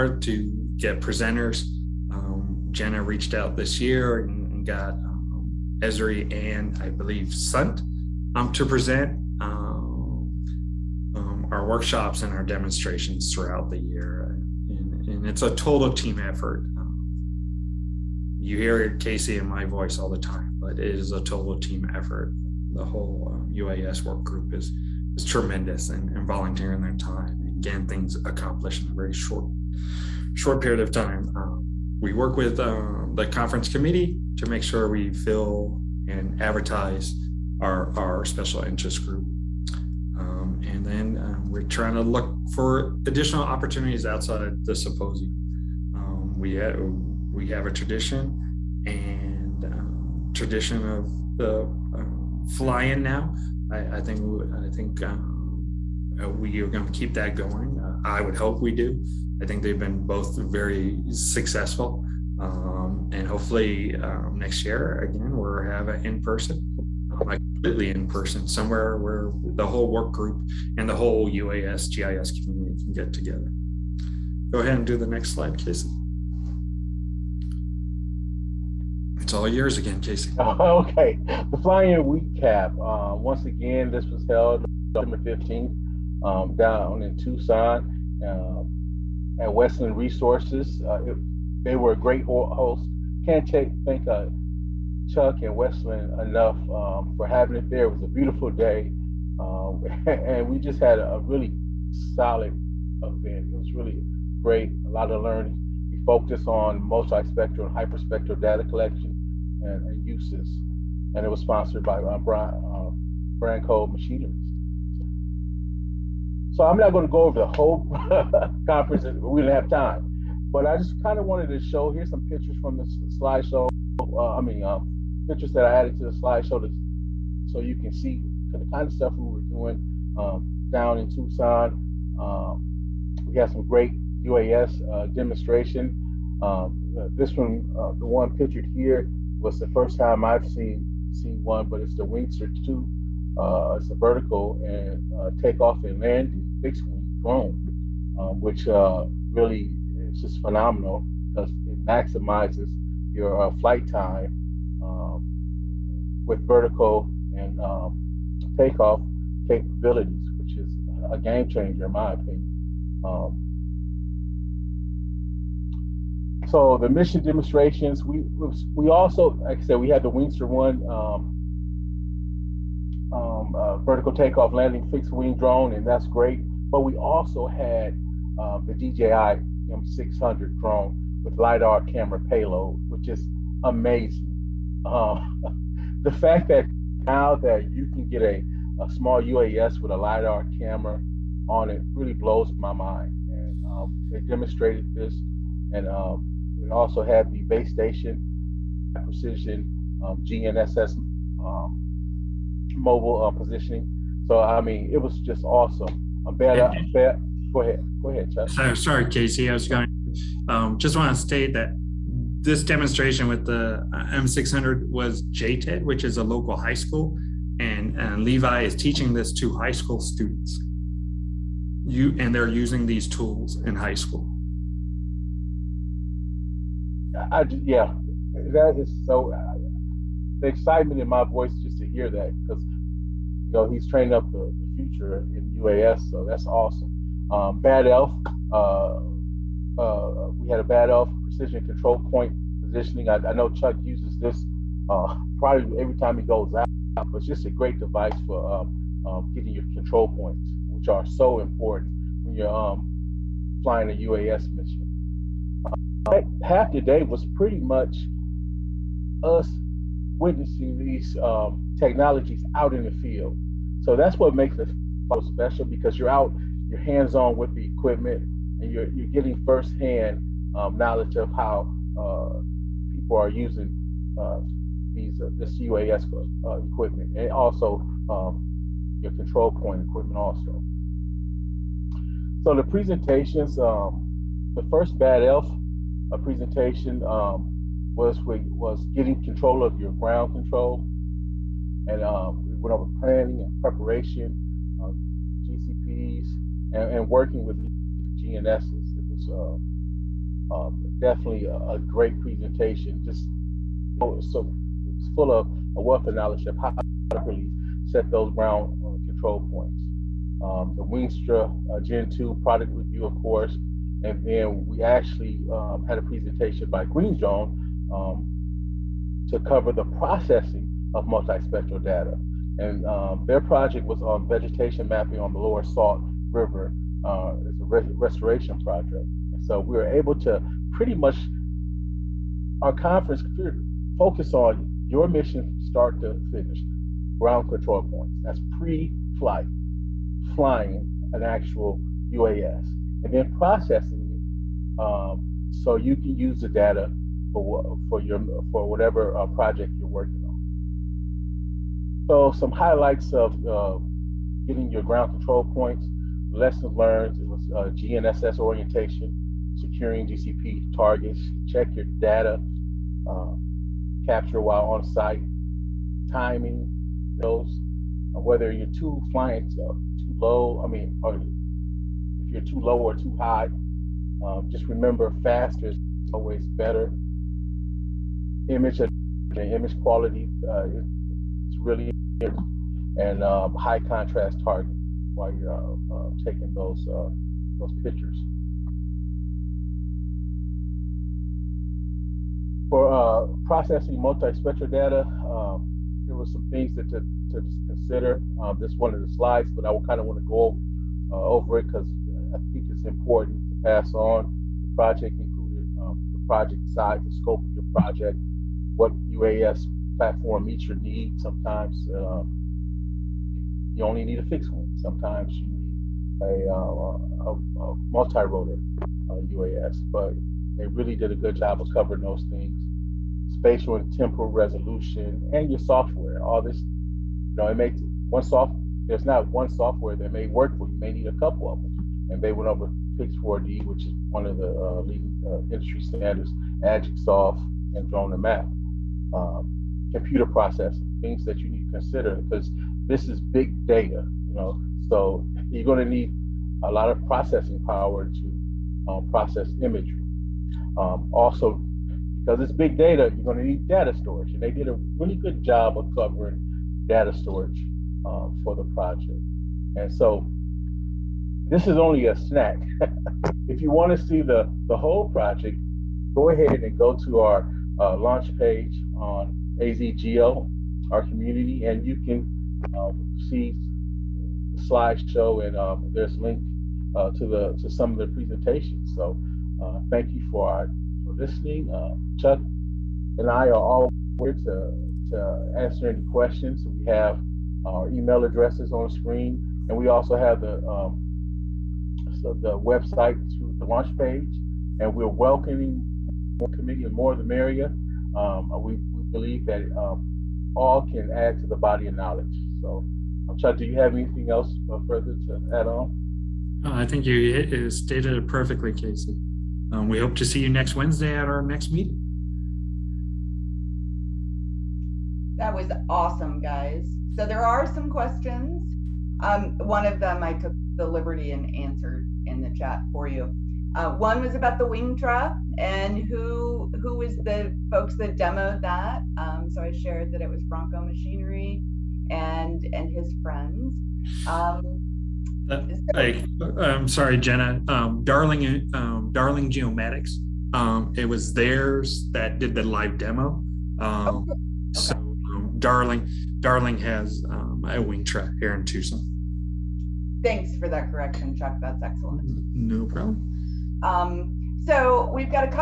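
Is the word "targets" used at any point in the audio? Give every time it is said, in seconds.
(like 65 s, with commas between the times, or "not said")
360 s, 384 s.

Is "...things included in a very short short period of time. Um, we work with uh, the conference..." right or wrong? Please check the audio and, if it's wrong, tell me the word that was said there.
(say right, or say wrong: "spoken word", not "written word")
wrong: "accomplished", not "included".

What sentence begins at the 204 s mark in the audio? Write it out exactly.
So I mean, it was just awesome.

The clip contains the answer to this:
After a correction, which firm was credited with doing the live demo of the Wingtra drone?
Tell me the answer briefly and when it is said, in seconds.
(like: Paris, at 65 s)
Darling Geomatics, at 539 s.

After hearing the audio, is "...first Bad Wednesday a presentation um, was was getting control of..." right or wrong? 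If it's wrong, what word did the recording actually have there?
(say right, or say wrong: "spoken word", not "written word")
wrong: "Elf", not "Wednesday".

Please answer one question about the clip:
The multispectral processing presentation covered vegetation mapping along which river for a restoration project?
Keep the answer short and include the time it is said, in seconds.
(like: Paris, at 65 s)
Lower Salt River, at 325 s.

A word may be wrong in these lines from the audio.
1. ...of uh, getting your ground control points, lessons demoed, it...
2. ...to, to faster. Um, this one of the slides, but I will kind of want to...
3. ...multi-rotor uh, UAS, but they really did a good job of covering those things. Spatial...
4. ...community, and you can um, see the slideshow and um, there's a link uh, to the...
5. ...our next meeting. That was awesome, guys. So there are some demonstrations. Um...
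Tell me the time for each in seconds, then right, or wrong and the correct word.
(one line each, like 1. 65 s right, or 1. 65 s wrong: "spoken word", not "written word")
1. 353 s wrong: "learned", not "demoed"
2. 396 s wrong: "consider", not "faster"
3. 417 s right
4. 471 s right
5. 511 s wrong: "questions", not "demonstrations".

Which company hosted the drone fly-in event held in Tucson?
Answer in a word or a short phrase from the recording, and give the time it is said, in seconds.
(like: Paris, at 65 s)
WestLand Resources, at 89 s.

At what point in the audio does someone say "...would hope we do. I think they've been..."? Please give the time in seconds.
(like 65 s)
58 s.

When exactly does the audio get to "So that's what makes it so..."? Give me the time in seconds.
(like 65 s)
263 s.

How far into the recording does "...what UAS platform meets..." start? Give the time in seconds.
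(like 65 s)
408 s.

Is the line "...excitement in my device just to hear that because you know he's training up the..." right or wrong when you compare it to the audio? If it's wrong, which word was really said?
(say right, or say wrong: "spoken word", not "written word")
wrong: "voice", not "device".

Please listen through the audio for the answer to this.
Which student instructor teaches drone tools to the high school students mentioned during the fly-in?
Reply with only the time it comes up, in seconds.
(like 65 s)
218 s.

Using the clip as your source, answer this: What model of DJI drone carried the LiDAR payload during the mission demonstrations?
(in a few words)
M600.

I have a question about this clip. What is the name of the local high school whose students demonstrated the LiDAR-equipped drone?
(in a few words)
JTED.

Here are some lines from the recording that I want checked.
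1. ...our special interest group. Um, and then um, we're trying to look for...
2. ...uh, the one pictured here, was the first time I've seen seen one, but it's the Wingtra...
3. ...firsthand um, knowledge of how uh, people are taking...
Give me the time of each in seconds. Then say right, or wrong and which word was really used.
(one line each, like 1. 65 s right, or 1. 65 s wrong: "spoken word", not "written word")
1. 37 s right
2. 137 s right
3. 269 s wrong: "using", not "taking".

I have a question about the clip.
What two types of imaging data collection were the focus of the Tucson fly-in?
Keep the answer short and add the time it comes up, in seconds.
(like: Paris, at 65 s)
Multispectral and hyperspectral, at 106 s.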